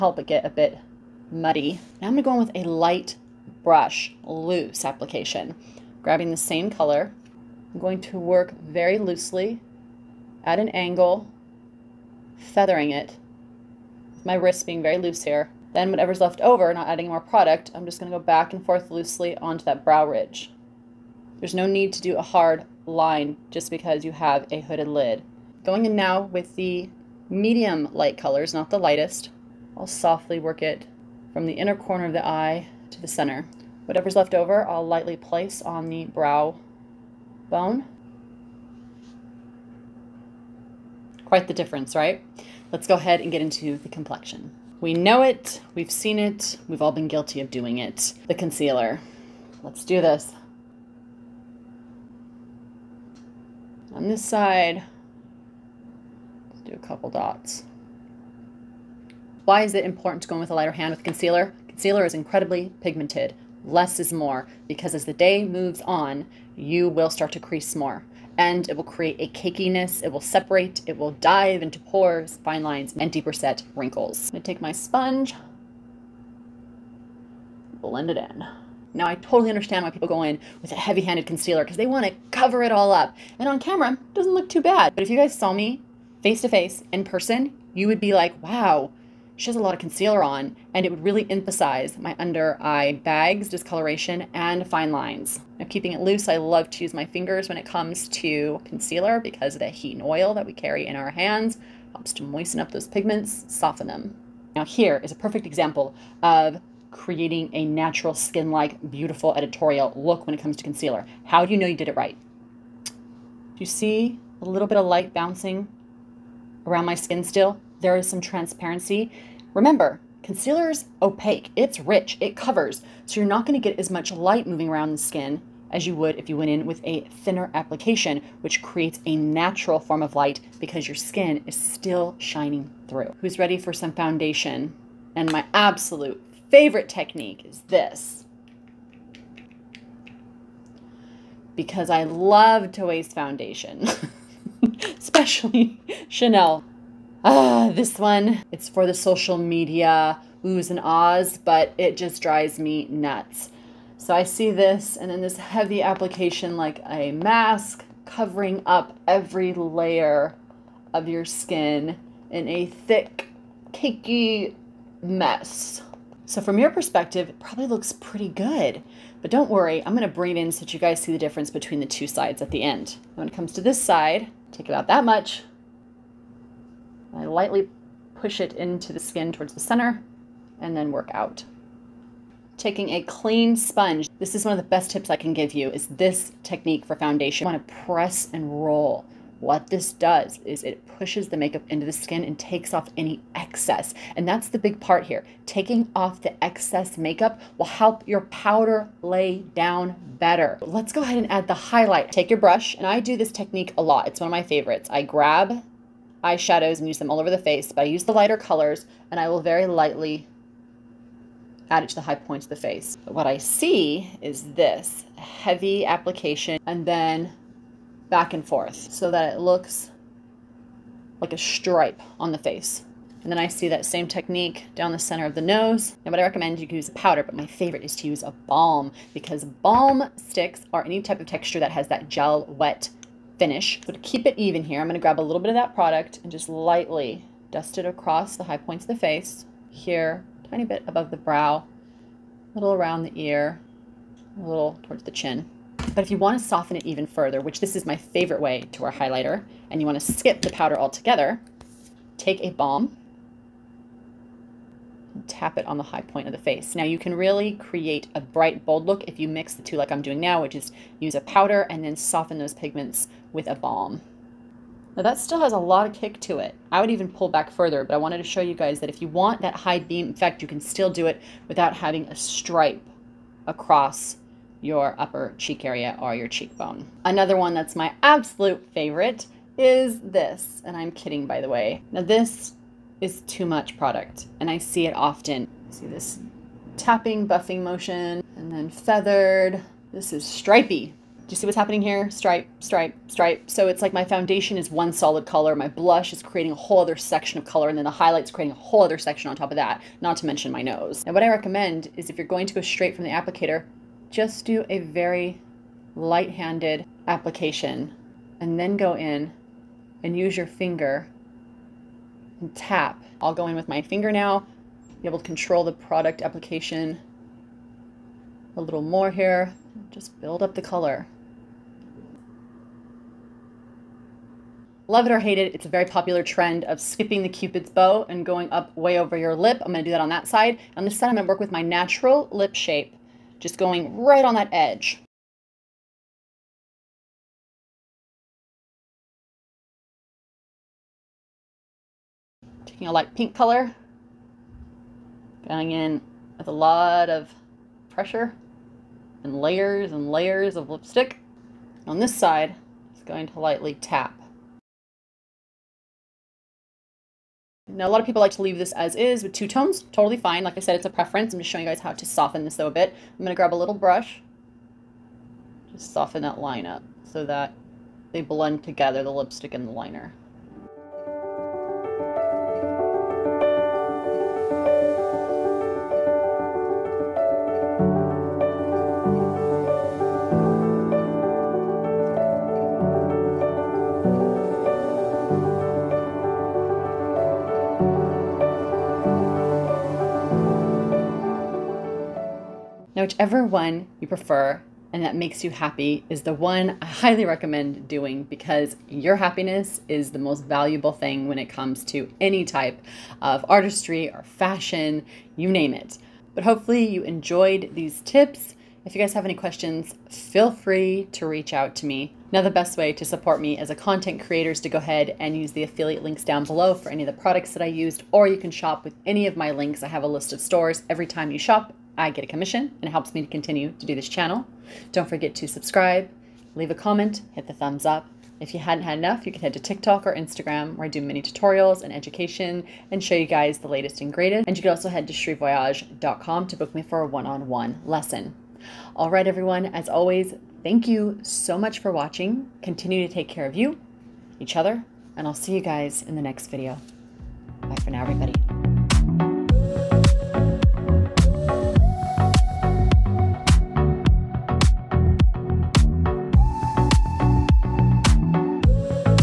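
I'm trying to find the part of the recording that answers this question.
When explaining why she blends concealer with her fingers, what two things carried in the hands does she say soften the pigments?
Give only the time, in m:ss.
1:39.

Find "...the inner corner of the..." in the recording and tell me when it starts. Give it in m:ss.
0:31.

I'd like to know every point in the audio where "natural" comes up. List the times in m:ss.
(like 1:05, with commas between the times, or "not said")
1:47, 2:09, 5:31.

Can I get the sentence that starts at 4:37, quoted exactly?
Another one that's my absolute favorite is this, and I'm kidding by the way.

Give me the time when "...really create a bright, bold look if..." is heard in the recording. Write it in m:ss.
4:17.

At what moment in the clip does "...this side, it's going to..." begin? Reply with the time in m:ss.
5:51.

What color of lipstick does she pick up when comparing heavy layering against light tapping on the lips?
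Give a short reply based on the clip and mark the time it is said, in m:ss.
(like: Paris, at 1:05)
light pink, at 5:42.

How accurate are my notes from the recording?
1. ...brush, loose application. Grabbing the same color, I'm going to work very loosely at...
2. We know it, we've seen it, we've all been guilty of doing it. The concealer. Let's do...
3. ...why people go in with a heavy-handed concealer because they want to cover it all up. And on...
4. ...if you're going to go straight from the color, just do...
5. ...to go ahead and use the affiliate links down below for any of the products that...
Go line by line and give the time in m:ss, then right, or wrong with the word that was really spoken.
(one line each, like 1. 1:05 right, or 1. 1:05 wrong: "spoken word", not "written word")
1. 0:03 right
2. 0:44 right
3. 1:19 right
4. 5:02 wrong: "applicator", not "color"
5. 6:54 right.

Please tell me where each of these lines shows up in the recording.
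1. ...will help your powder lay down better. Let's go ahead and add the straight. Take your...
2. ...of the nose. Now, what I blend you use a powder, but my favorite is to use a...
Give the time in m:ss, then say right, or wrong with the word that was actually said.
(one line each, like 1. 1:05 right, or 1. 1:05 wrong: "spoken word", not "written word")
1. 3:17 wrong: "highlight", not "straight"
2. 3:45 wrong: "recommend", not "blend".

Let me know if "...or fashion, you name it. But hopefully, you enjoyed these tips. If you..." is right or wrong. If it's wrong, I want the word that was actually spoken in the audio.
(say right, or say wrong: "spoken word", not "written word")
right.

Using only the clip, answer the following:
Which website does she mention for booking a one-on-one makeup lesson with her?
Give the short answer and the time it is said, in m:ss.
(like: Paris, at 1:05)
cherivoyage.com, at 7:15.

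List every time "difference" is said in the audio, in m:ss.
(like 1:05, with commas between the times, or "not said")
0:41, 2:51.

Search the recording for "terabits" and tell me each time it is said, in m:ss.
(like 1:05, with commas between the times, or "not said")
not said.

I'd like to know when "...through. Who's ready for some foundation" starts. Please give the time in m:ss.
2:12.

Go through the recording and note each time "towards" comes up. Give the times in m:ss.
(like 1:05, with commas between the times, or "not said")
2:59, 4:04.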